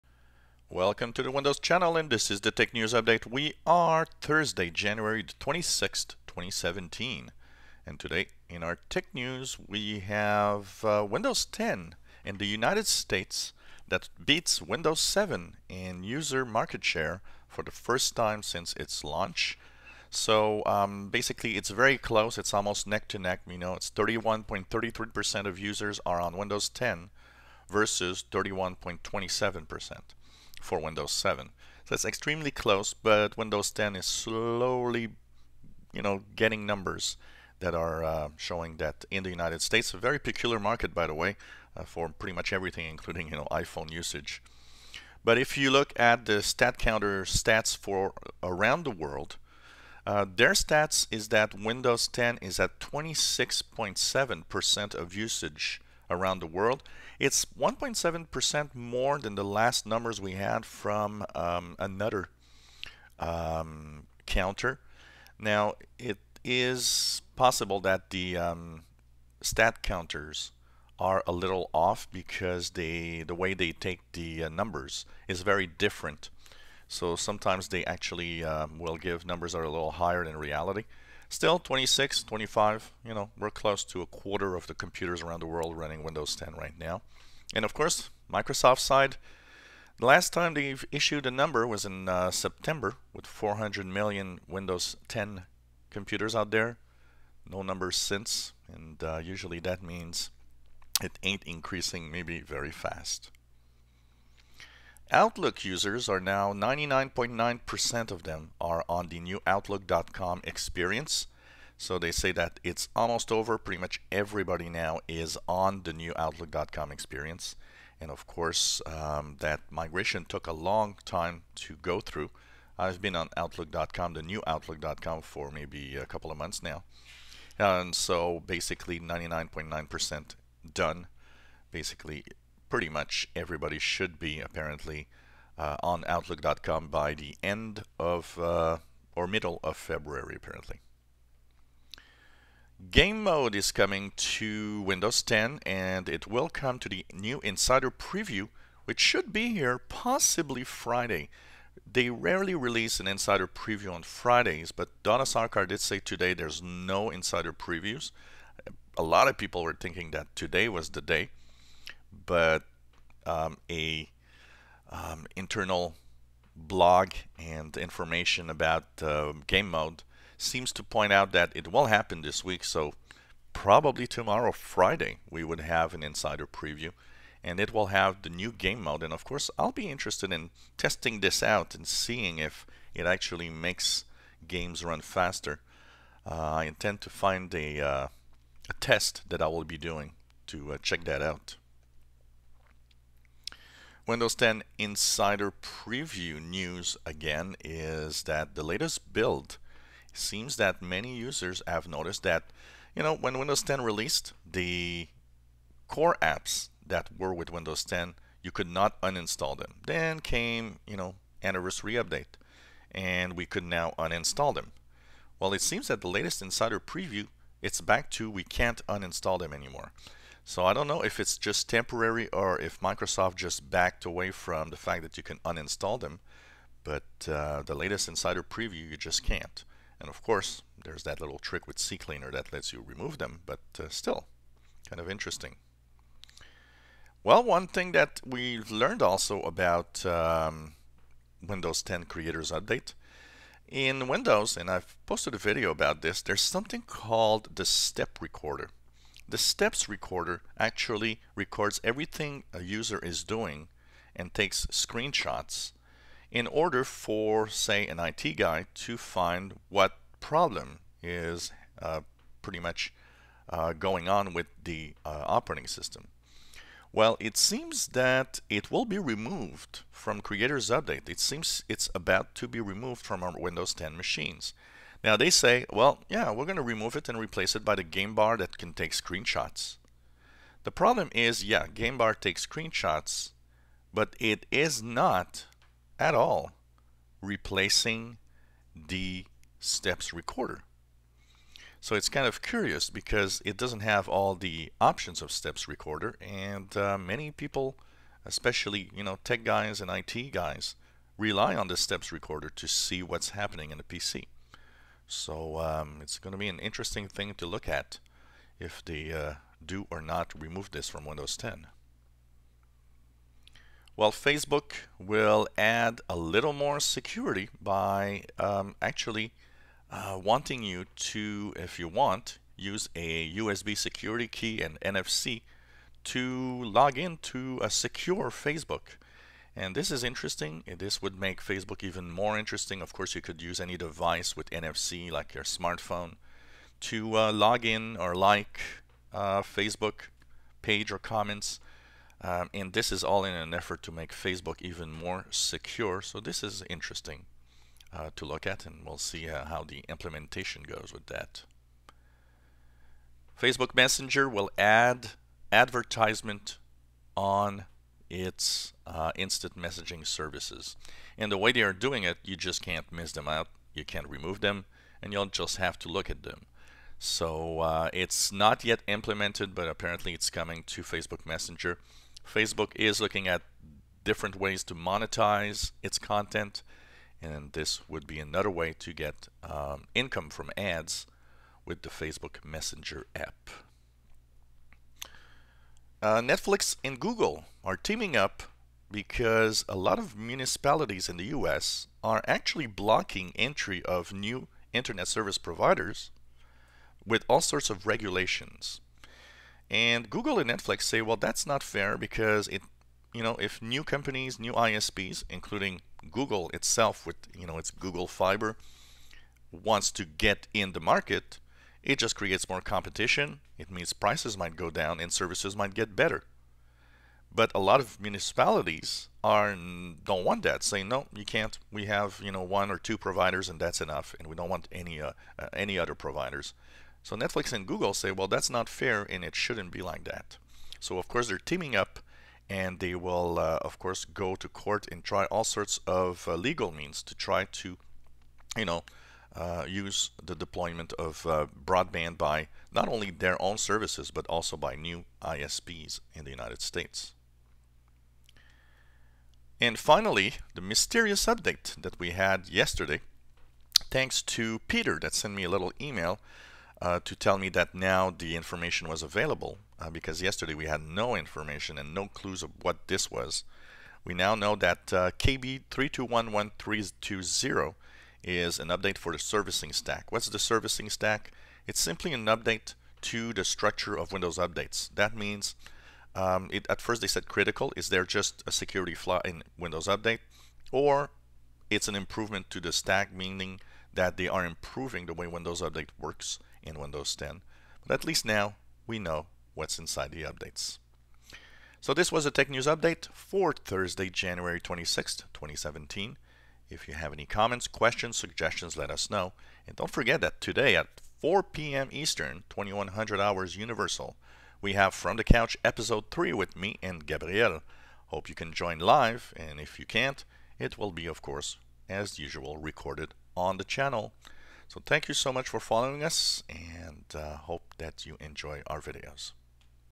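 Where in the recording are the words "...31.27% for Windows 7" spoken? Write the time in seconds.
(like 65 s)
28 s.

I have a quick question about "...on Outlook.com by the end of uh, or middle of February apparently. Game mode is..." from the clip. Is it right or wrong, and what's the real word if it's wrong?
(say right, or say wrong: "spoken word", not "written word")
right.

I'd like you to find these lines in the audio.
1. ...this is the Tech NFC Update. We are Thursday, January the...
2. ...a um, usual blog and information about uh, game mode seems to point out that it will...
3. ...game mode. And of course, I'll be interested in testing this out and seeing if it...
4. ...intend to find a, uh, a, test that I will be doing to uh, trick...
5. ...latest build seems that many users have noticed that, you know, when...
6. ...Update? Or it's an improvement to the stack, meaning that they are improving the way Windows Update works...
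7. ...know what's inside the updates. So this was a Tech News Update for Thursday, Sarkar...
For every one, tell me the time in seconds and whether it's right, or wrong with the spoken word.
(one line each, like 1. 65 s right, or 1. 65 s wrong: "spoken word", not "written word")
1. 2 s wrong: "News", not "NFC"
2. 163 s wrong: "internal", not "usual"
3. 178 s right
4. 186 s wrong: "check", not "trick"
5. 198 s right
6. 479 s right
7. 488 s wrong: "January", not "Sarkar".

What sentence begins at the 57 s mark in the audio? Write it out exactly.
It's 1.7% more than the last numbers we had from um, another um, counter.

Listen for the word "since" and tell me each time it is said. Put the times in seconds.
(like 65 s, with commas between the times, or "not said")
18 s, 97 s.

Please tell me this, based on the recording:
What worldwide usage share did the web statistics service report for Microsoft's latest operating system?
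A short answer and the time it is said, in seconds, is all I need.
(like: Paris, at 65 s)
26.7%, at 52 s.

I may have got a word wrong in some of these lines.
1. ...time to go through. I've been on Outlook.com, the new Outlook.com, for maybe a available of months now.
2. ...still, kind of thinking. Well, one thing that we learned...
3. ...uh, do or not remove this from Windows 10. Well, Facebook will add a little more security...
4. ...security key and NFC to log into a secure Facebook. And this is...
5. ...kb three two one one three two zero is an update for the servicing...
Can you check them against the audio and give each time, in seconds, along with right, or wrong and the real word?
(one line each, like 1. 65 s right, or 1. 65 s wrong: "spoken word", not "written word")
1. 121 s wrong: "couple", not "available"
2. 233 s wrong: "interesting", not "thinking"
3. 309 s right
4. 323 s right
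5. 465 s right.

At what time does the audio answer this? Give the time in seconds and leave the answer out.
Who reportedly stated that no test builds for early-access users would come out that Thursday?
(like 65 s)
155 s.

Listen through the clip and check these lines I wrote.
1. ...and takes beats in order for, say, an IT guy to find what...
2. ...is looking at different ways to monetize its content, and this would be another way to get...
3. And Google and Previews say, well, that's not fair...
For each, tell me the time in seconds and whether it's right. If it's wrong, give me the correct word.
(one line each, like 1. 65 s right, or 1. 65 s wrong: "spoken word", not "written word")
1. 254 s wrong: "screenshots", not "beats"
2. 372 s right
3. 399 s wrong: "Netflix", not "Previews".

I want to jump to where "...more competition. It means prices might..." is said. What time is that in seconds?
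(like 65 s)
412 s.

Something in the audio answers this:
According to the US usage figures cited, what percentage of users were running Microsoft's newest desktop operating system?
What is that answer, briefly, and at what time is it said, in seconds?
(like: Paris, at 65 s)
31.33%, at 23 s.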